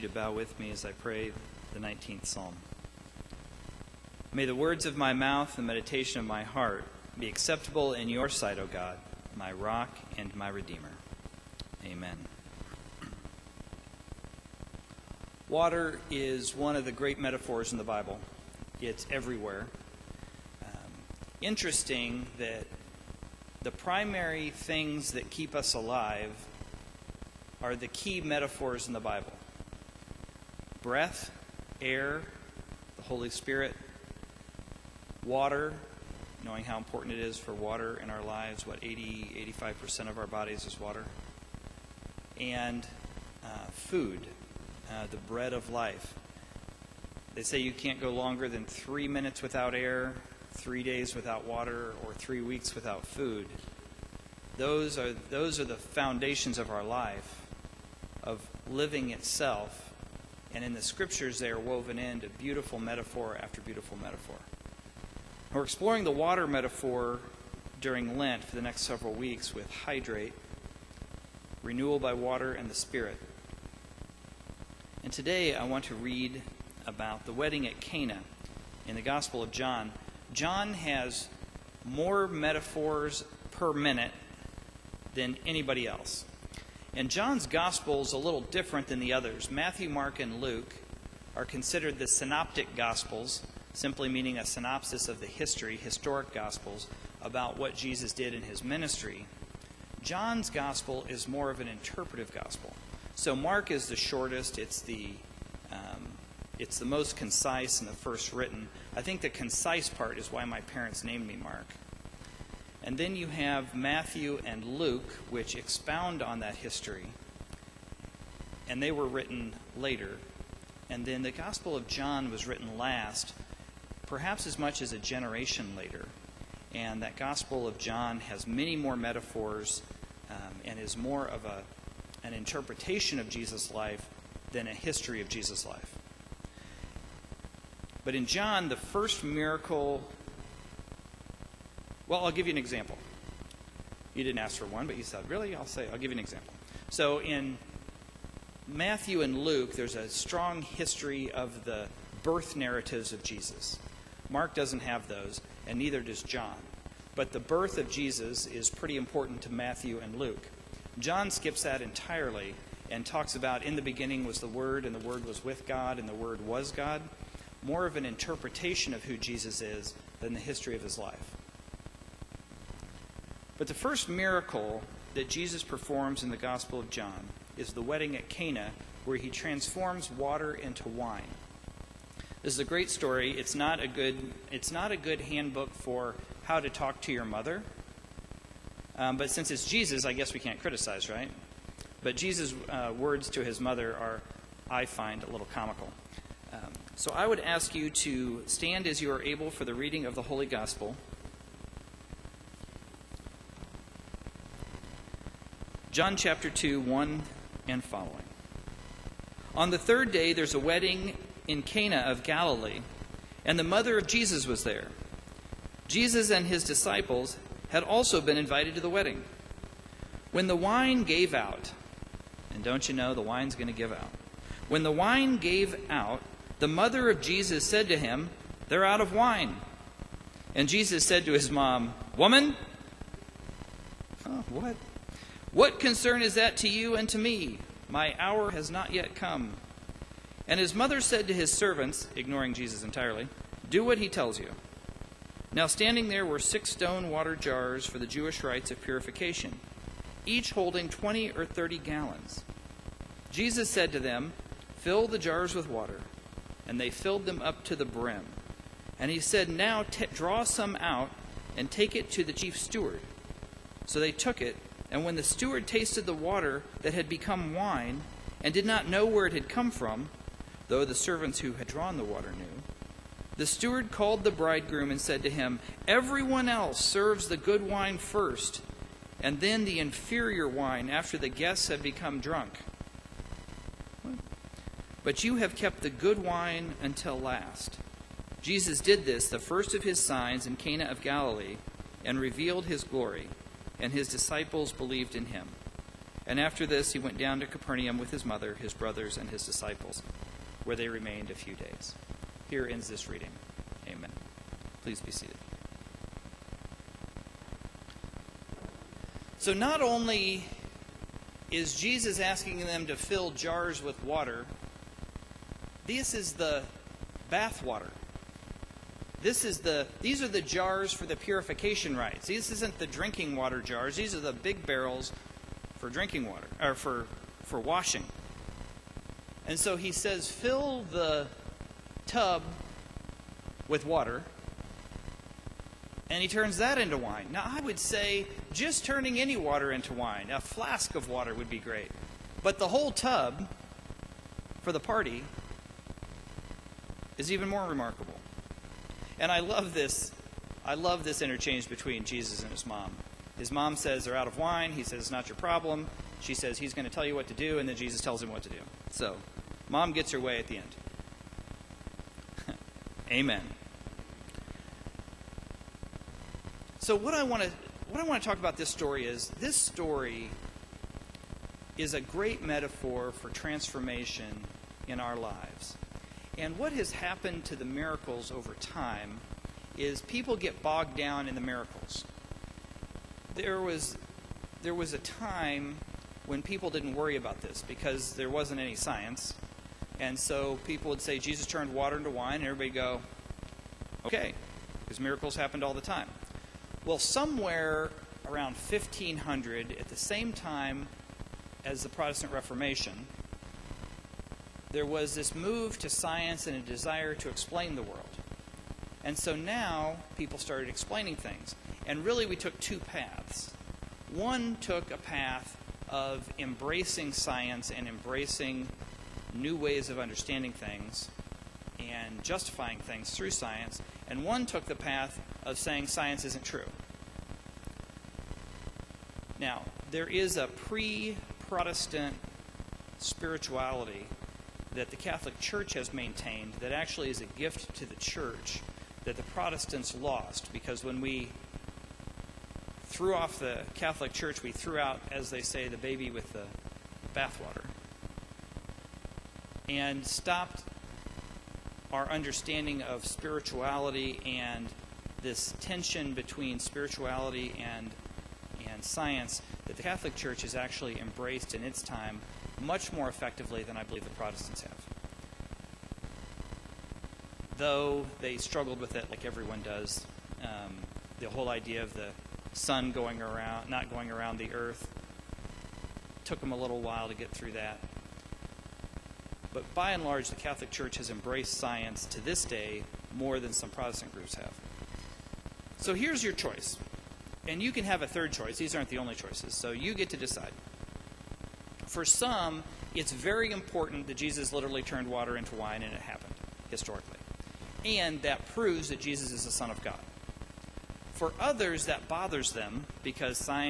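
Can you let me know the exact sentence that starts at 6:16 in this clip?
And what has happened to the miracles over time is people get bogged down in the miracles.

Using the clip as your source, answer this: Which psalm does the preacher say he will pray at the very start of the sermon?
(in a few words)
19th Psalm.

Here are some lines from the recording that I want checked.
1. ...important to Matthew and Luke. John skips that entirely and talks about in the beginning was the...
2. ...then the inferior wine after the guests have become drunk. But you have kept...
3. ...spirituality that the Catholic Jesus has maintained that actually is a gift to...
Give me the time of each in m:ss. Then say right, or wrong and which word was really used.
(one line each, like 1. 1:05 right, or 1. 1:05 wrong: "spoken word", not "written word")
1. 2:38 right
2. 4:39 right
3. 7:12 wrong: "Church", not "Jesus".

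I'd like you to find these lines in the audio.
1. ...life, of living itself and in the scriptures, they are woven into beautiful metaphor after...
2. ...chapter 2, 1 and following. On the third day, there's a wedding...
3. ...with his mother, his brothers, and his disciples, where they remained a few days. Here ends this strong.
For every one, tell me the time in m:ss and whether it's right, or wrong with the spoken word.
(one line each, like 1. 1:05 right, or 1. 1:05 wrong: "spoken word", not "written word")
1. 0:56 right
2. 3:26 right
3. 4:57 wrong: "reading", not "strong".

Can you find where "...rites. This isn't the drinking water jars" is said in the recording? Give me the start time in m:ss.
5:21.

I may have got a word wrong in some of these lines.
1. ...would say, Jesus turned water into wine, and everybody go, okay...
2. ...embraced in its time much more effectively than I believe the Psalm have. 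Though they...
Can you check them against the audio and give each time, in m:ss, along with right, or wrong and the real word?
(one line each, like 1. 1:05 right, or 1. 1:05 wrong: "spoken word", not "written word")
1. 6:30 right
2. 7:40 wrong: "Protestants", not "Psalm".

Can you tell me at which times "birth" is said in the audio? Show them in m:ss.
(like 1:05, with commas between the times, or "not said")
2:32, 2:37.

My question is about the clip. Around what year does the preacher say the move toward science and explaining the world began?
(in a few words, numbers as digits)
1500.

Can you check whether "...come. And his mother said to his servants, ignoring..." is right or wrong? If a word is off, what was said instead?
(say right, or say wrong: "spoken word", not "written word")
right.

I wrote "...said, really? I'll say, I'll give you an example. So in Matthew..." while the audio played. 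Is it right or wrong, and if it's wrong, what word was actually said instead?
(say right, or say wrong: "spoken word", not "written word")
right.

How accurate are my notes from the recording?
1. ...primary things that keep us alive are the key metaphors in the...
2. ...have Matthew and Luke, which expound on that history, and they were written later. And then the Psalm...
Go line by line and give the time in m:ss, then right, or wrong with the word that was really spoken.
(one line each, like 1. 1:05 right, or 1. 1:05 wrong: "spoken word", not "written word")
1. 0:23 right
2. 1:53 wrong: "Gospel", not "Psalm".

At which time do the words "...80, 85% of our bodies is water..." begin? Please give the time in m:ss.
0:38.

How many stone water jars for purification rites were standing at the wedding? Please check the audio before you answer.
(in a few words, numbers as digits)
6.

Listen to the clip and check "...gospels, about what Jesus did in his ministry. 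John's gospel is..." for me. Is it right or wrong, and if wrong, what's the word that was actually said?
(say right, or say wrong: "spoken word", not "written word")
right.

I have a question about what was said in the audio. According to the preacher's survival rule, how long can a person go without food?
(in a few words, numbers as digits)
3 weeks.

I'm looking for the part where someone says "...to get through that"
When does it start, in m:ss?
7:57.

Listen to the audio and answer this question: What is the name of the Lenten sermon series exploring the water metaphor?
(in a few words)
Hydrate.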